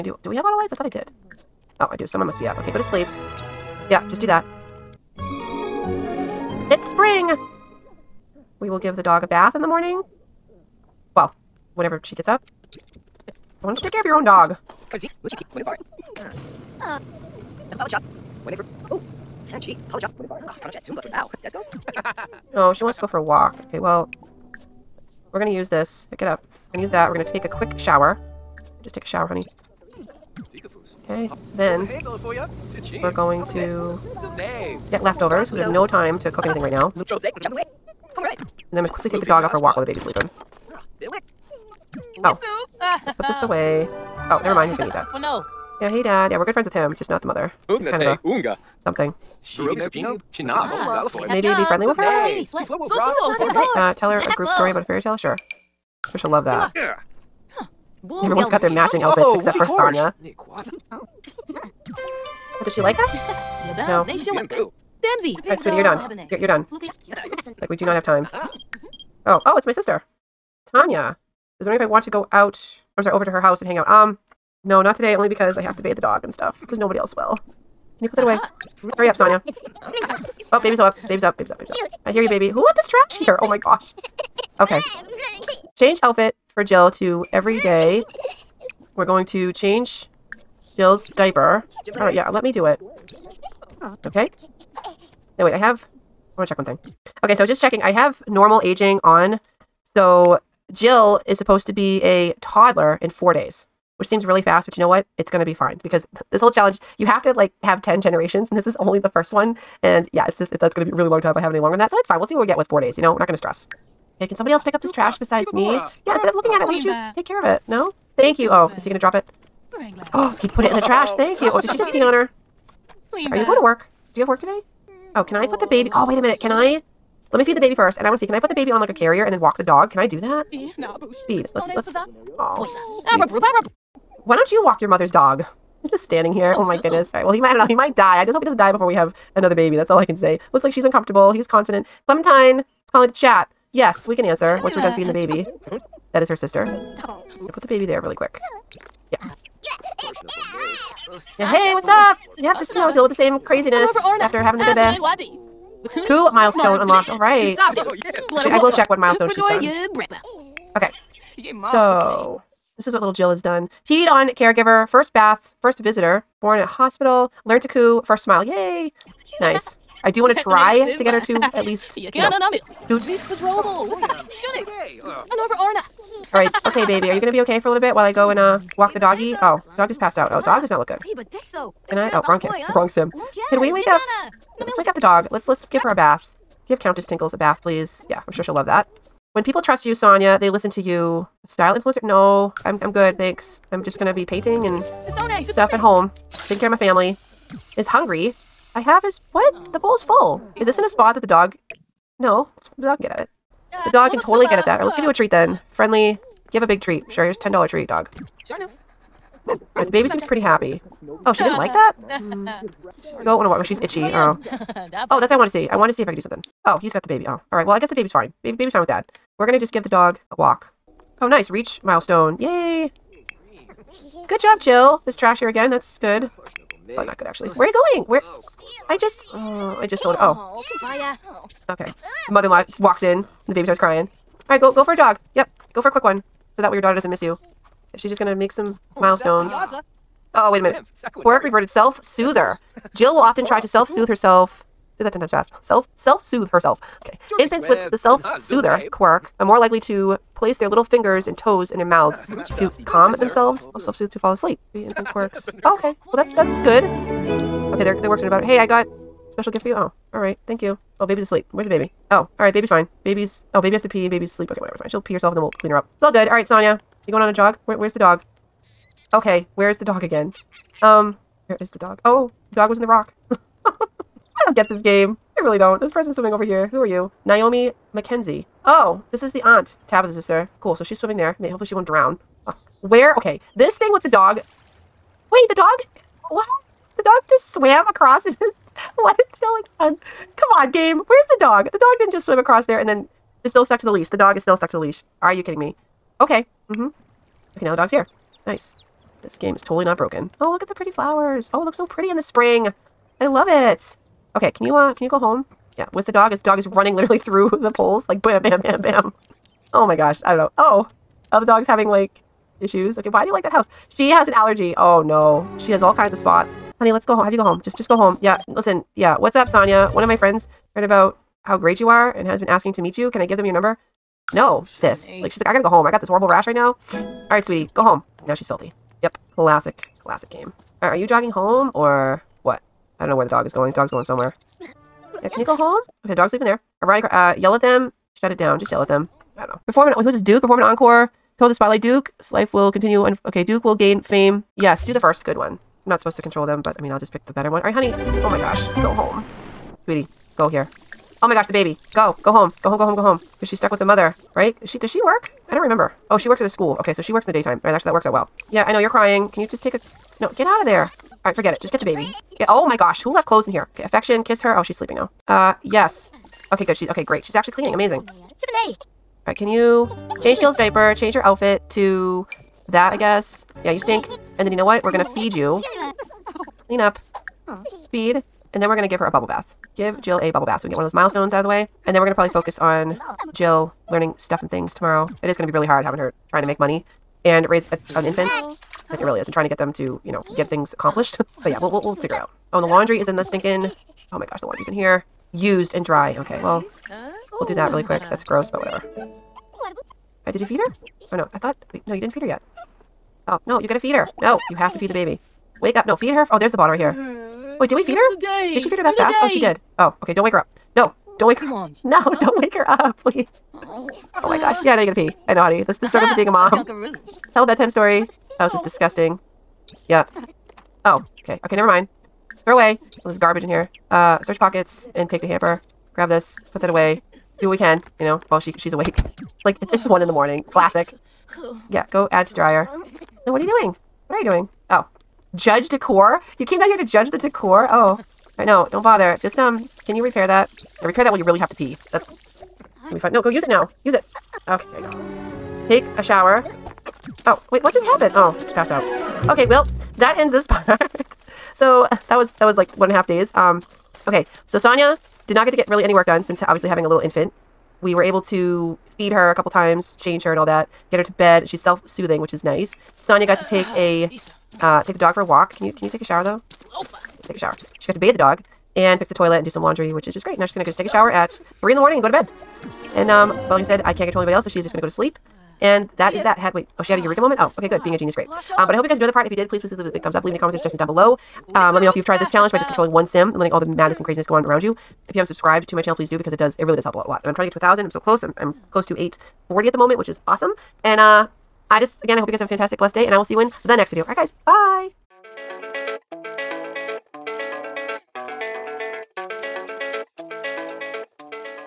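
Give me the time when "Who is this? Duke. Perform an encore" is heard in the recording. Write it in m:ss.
5:40.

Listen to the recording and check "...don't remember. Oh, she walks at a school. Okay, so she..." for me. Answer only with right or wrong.
wrong.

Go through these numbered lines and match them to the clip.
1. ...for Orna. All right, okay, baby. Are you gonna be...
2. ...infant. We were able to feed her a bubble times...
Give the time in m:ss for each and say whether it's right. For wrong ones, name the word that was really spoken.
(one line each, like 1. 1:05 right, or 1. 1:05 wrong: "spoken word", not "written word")
1. 2:55 right
2. 7:36 wrong: "couple", not "bubble".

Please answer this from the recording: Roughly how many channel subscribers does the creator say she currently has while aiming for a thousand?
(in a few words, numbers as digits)
840.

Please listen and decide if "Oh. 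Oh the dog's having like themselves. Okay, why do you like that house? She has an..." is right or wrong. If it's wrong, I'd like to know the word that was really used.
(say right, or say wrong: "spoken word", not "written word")
wrong: "issues", not "themselves".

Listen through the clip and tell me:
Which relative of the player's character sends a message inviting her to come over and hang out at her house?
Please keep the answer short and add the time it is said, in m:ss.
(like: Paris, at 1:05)
Tanya, at 1:10.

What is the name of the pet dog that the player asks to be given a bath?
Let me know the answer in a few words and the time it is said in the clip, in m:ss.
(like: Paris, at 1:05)
Countess Tinkles, at 3:06.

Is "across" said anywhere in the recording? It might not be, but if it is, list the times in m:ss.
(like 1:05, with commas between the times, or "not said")
4:47, 4:52.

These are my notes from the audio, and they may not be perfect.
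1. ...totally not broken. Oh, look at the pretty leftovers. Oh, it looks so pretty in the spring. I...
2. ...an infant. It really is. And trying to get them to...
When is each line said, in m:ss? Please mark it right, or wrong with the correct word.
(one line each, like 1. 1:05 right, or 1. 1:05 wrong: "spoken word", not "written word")
1. 4:59 wrong: "flowers", not "leftovers"
2. 6:27 right.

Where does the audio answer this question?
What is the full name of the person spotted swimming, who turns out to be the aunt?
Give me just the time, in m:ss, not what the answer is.
4:37.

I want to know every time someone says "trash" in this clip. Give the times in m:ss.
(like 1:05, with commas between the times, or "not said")
1:22, 1:54, 2:00, 3:45.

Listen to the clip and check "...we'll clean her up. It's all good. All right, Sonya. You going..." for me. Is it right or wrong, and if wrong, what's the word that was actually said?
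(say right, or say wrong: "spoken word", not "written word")
right.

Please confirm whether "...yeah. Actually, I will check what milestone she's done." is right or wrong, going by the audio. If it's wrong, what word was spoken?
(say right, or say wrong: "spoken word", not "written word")
right.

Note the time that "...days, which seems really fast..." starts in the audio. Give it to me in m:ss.
1:43.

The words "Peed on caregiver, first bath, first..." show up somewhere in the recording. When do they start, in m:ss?
2:43.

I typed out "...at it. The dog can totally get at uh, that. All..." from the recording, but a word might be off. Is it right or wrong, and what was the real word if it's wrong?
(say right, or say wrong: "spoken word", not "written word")
right.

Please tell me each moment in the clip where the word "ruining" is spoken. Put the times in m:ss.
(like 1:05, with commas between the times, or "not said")
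not said.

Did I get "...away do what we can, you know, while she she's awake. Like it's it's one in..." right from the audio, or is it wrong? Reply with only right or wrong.
right.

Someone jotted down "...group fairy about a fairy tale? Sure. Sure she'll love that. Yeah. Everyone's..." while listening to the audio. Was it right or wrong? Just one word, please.
wrong.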